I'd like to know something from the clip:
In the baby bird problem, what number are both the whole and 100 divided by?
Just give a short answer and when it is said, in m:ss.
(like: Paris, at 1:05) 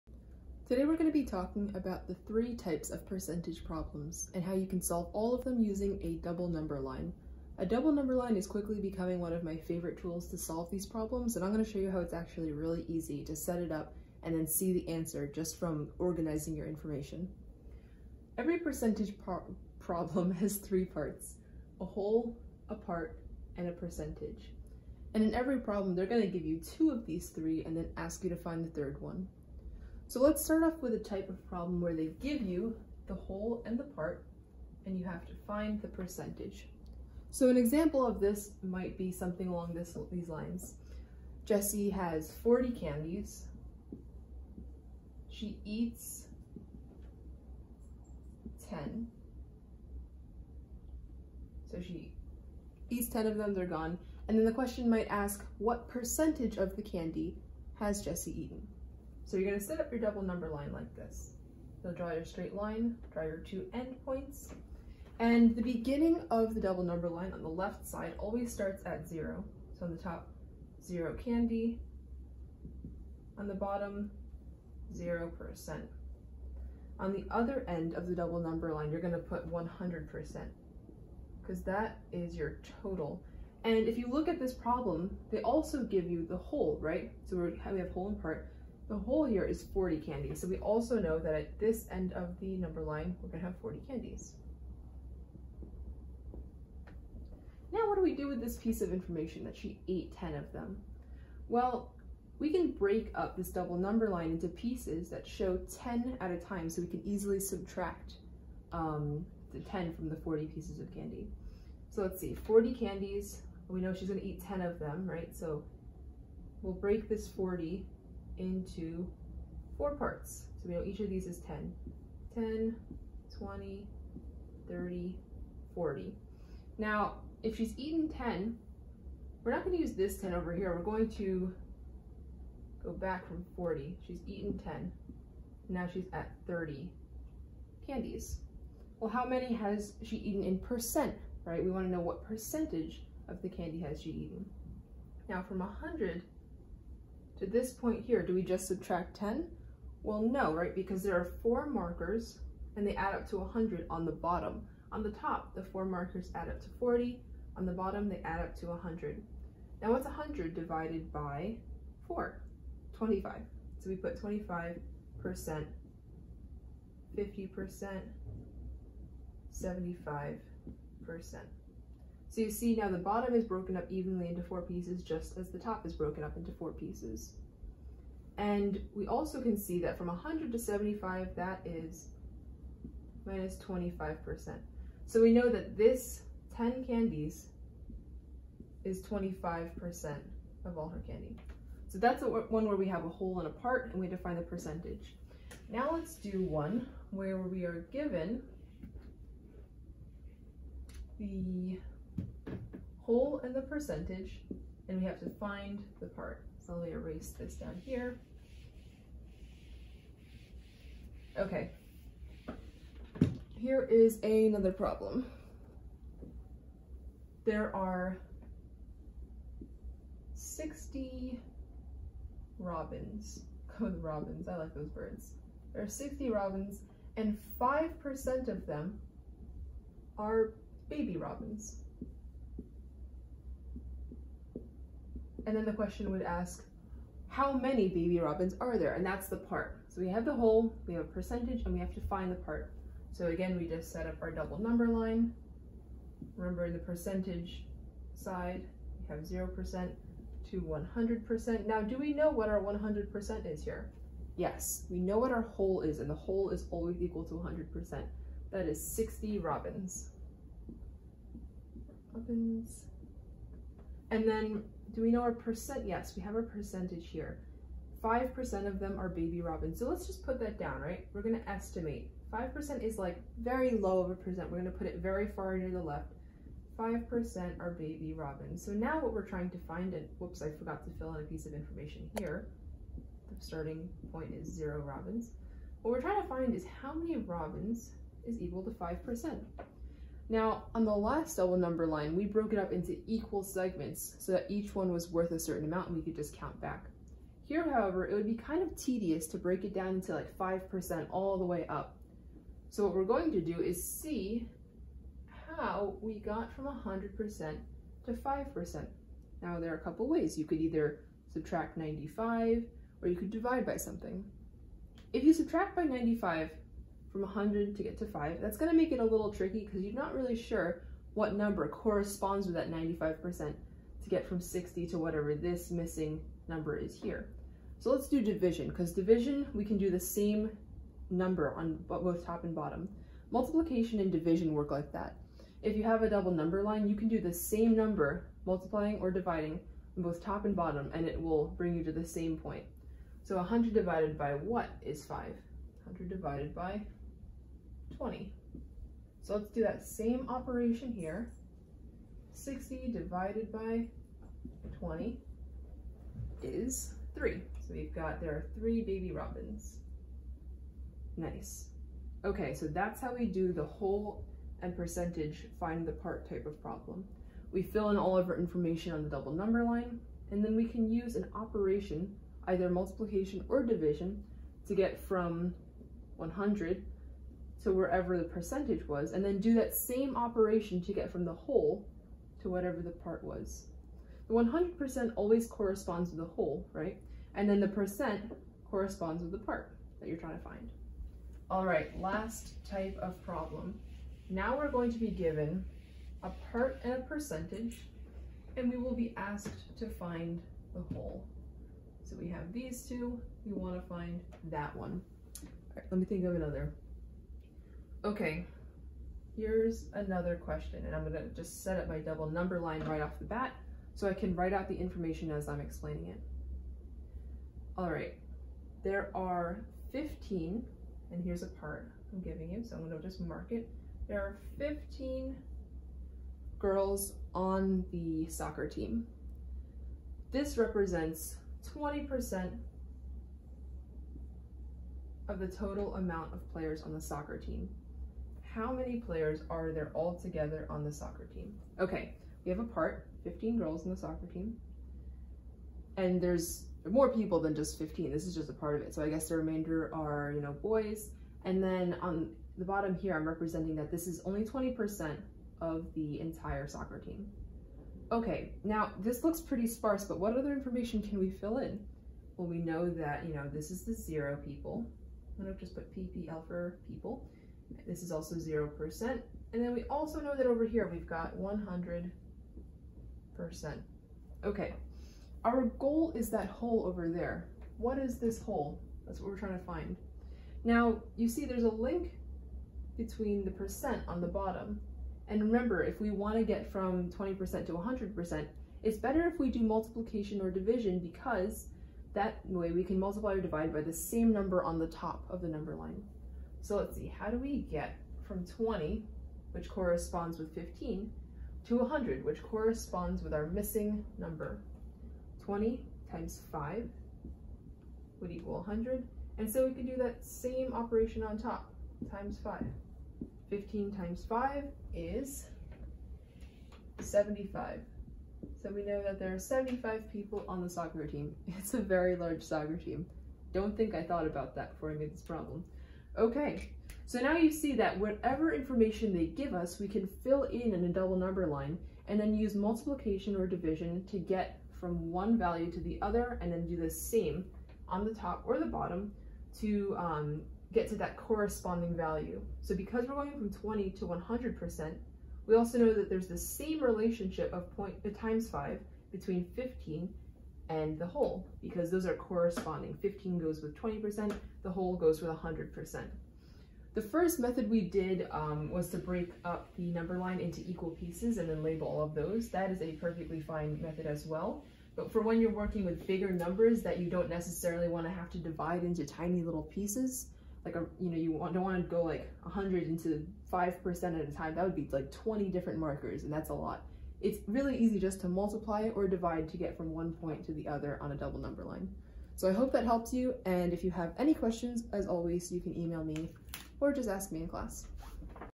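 20, at 5:45.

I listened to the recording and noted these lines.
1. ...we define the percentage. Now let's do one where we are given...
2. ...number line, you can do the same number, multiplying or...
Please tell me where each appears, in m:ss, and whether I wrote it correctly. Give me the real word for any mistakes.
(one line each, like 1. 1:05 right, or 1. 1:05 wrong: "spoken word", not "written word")
1. 3:13 right
2. 5:36 right.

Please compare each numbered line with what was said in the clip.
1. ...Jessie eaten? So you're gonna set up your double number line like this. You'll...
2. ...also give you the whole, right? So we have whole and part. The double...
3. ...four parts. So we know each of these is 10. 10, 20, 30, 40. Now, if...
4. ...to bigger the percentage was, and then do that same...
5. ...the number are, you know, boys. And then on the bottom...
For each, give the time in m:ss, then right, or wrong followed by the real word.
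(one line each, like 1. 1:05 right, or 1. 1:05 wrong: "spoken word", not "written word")
1. 0:58 right
2. 1:25 wrong: "whole", not "double"
3. 1:59 right
4. 6:17 wrong: "wherever", not "bigger"
5. 7:29 wrong: "remainder", not "number".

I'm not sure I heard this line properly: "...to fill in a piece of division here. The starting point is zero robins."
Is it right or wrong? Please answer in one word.
wrong.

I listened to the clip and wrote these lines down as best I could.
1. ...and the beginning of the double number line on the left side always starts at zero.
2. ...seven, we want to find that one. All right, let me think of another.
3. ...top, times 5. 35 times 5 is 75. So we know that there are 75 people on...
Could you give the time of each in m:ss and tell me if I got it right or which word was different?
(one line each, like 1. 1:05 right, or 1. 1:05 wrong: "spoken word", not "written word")
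1. 1:05 right
2. 6:42 wrong: "two", not "seven"
3. 8:31 wrong: "15", not "35".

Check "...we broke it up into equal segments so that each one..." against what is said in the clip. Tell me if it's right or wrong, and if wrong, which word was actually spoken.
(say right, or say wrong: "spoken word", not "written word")
right.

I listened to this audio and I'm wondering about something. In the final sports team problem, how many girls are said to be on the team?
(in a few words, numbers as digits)
15.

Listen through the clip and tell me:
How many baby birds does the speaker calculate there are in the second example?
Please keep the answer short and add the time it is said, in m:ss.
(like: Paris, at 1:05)
3, at 5:58.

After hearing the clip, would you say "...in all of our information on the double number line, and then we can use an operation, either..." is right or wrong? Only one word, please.
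right.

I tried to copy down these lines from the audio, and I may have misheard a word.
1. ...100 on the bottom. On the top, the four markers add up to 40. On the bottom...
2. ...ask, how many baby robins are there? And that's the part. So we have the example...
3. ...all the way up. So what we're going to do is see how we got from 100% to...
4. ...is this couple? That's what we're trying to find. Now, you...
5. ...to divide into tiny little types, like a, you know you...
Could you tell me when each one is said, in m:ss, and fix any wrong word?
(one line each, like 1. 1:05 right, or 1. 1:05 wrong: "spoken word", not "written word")
1. 2:33 right
2. 3:56 wrong: "whole", not "example"
3. 5:01 right
4. 7:57 wrong: "whole", not "couple"
5. 9:28 wrong: "pieces", not "types".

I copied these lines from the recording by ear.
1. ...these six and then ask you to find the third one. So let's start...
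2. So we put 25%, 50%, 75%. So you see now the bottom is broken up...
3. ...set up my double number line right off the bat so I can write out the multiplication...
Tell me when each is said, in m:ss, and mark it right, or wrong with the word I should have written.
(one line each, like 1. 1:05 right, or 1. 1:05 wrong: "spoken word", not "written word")
1. 0:27 wrong: "three", not "six"
2. 2:43 right
3. 6:51 wrong: "information", not "multiplication".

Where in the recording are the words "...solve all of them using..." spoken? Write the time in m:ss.
0:04.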